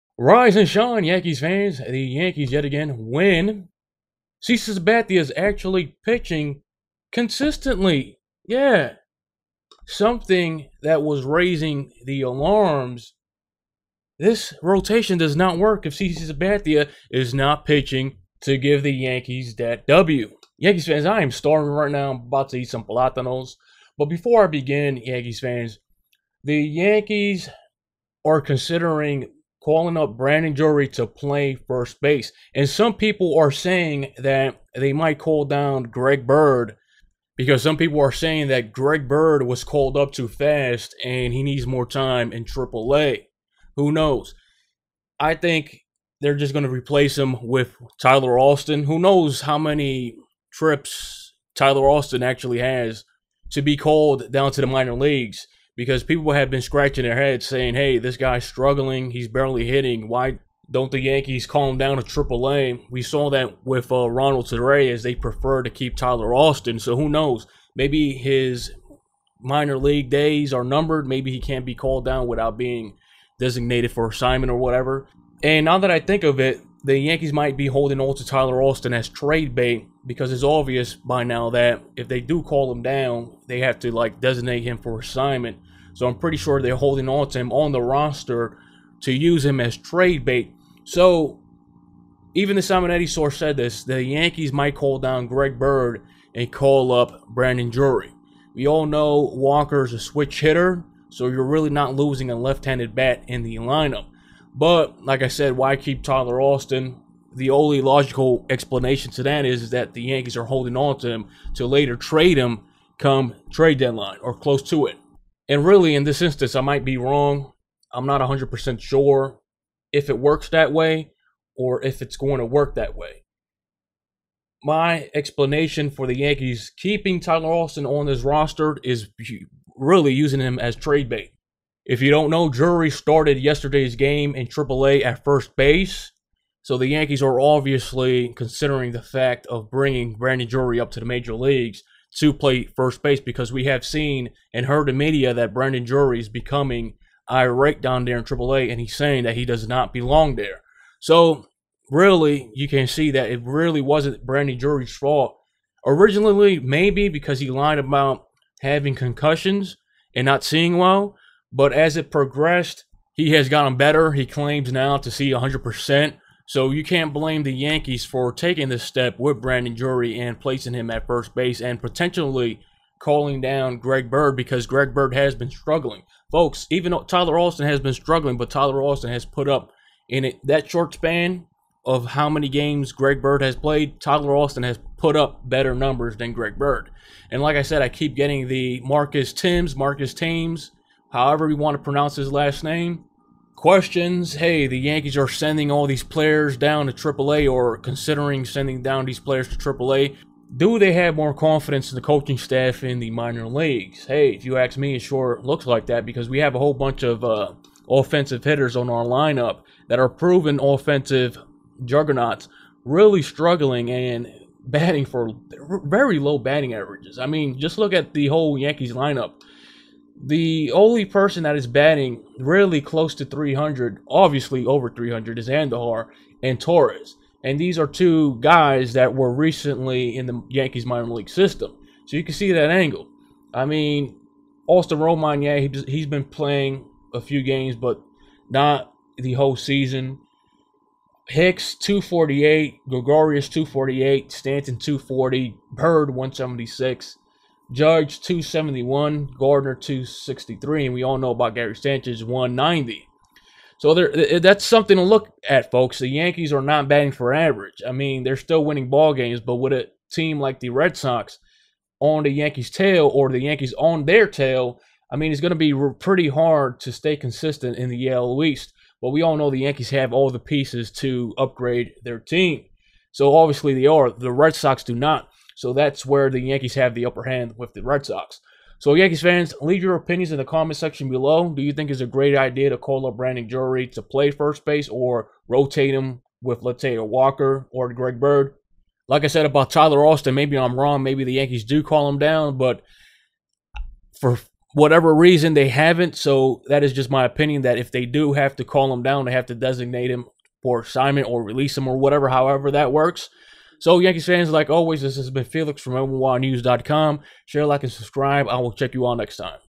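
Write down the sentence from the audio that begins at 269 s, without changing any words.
But we all know the Yankees have all the pieces to upgrade their team.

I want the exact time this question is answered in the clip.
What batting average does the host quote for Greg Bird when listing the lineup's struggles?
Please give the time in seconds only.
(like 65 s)
245 s.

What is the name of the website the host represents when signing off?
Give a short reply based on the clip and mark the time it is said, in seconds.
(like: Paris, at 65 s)
NYYNews.com, at 305 s.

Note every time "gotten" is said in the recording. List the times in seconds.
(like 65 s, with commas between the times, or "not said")
163 s.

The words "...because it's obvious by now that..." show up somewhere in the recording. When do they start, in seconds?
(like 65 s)
80 s.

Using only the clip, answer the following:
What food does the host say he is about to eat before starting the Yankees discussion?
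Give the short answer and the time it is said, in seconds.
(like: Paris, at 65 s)
platanos, at 22 s.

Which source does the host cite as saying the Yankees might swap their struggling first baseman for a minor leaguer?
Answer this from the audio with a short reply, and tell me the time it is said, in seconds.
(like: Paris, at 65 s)
Simonetti, at 92 s.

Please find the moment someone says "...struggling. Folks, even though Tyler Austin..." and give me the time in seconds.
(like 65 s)
175 s.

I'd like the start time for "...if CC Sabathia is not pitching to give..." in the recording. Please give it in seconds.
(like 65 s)
15 s.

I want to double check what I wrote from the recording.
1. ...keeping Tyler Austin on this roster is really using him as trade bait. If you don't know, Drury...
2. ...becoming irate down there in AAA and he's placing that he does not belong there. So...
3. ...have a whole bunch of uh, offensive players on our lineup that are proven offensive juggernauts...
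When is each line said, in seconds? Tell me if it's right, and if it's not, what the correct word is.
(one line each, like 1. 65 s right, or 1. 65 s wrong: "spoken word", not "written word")
1. 126 s right
2. 146 s wrong: "saying", not "placing"
3. 206 s wrong: "hitters", not "players".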